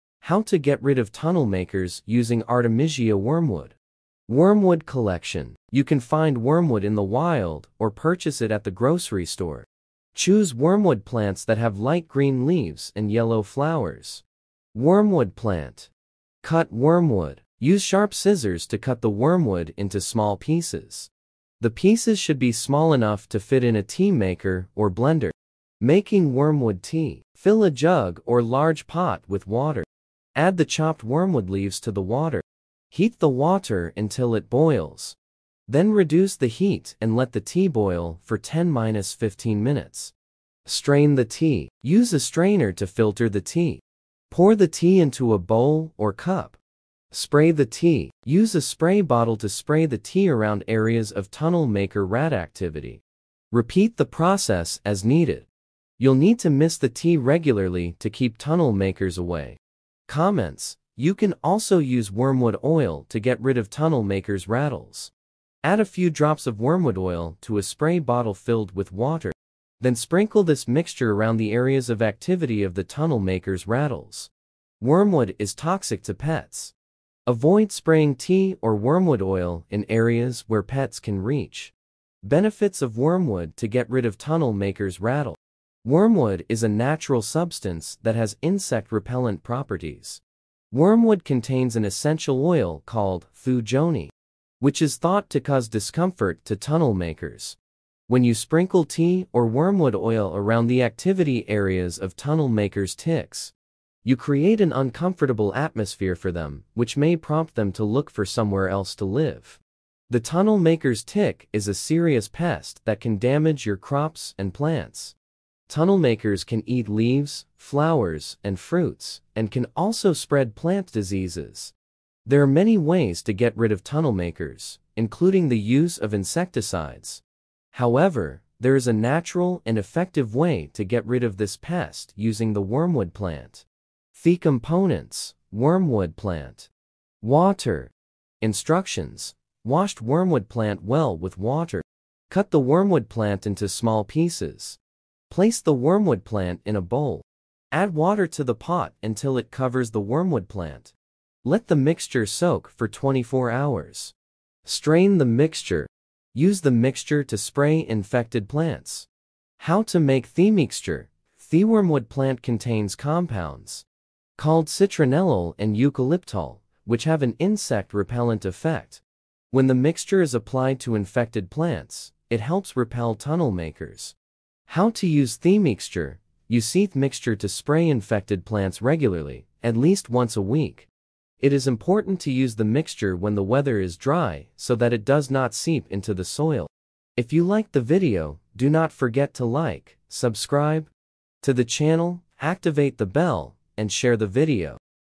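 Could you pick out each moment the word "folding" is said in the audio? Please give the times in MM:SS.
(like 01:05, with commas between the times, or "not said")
not said.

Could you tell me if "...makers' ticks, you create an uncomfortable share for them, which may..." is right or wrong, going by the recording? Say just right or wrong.
wrong.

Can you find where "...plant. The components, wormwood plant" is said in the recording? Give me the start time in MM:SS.
02:13.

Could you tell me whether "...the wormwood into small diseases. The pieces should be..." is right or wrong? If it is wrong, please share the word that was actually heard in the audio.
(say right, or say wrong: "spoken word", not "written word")
wrong: "pieces", not "diseases".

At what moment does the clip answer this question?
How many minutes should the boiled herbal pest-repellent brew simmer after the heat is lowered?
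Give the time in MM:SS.
00:38.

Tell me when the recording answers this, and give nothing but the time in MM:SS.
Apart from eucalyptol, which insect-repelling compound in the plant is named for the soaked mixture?
02:44.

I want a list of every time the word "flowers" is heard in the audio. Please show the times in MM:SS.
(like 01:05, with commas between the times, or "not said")
00:13, 01:57.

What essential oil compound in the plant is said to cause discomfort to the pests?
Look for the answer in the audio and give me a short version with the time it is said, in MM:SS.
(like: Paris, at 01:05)
thujone, at 01:33.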